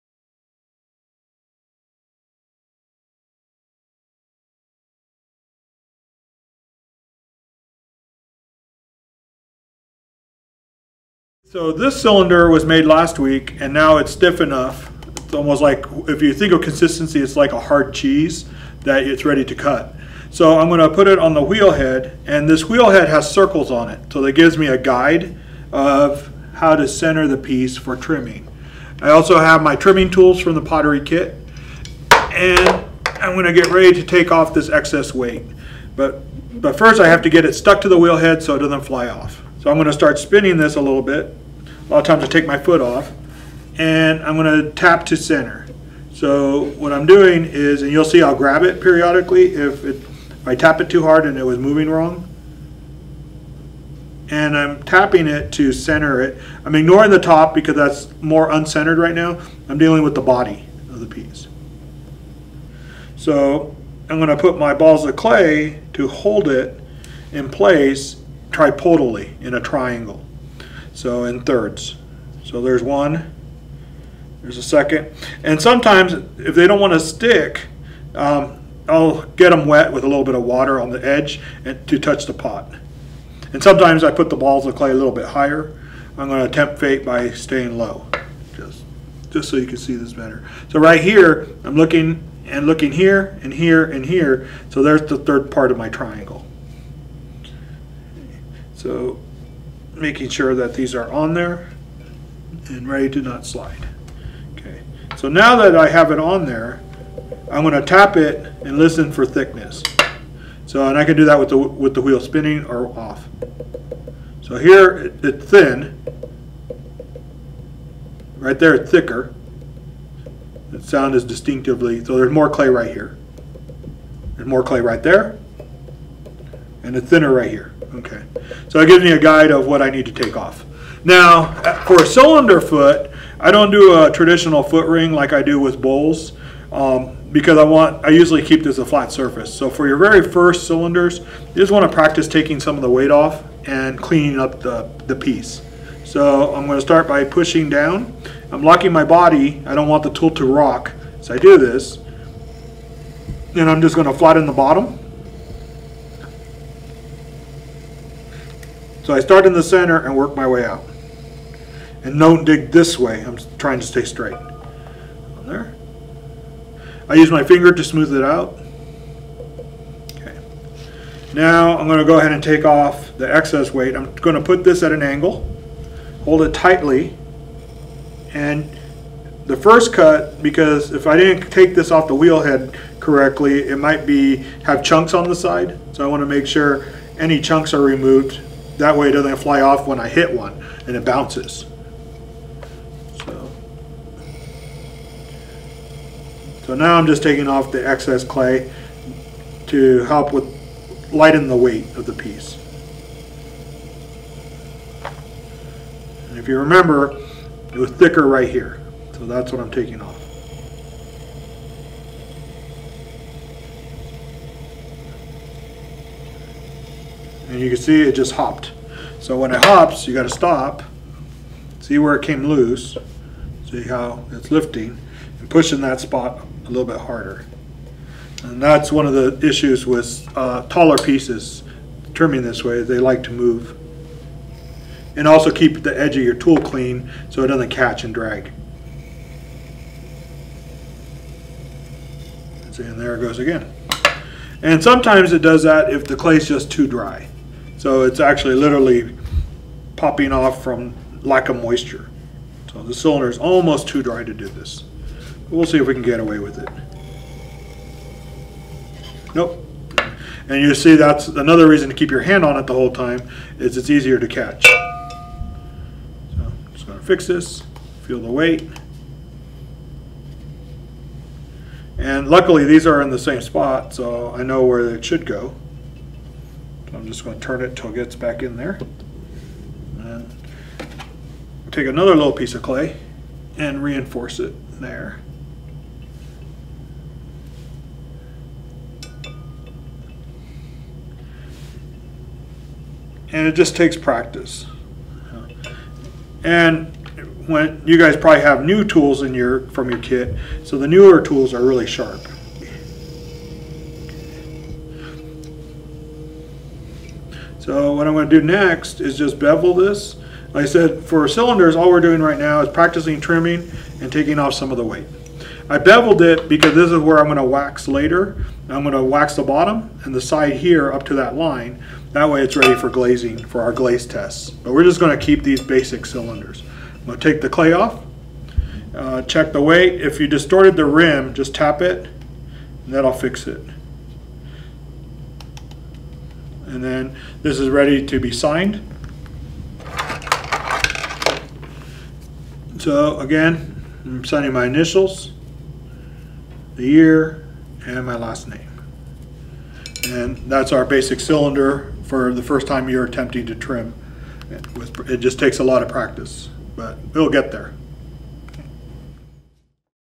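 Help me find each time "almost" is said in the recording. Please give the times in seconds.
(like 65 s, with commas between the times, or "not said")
15 s, 253 s.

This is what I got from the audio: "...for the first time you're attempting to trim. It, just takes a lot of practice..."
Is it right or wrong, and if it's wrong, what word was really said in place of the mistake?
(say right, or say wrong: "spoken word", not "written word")
right.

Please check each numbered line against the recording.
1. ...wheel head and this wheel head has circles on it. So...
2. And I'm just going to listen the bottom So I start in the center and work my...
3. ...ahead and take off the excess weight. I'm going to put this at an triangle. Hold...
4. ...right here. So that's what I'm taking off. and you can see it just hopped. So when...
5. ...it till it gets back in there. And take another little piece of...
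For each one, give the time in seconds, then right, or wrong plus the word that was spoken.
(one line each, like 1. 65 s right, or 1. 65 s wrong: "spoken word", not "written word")
1. 21 s right
2. 153 s wrong: "flatten", not "listen"
3. 172 s wrong: "angle", not "triangle"
4. 208 s right
5. 277 s right.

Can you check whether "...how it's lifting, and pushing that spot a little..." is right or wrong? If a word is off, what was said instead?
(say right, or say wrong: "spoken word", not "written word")
right.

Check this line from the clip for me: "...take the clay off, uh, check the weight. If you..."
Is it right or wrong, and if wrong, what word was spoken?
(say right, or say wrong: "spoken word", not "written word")
right.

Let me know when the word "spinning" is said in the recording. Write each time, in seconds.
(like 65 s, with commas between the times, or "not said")
40 s, 112 s.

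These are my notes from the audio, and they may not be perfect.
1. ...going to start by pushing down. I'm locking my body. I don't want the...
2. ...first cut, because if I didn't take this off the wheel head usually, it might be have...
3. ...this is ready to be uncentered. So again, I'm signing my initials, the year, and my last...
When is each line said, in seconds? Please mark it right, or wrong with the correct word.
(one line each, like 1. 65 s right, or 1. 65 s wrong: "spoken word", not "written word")
1. 146 s right
2. 179 s wrong: "correctly", not "usually"
3. 337 s wrong: "signed", not "uncentered".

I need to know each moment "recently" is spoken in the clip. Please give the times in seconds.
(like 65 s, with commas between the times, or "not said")
not said.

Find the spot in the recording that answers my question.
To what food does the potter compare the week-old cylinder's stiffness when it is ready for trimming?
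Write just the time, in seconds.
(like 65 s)
17 s.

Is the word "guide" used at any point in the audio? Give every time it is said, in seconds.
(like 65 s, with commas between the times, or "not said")
24 s, 129 s.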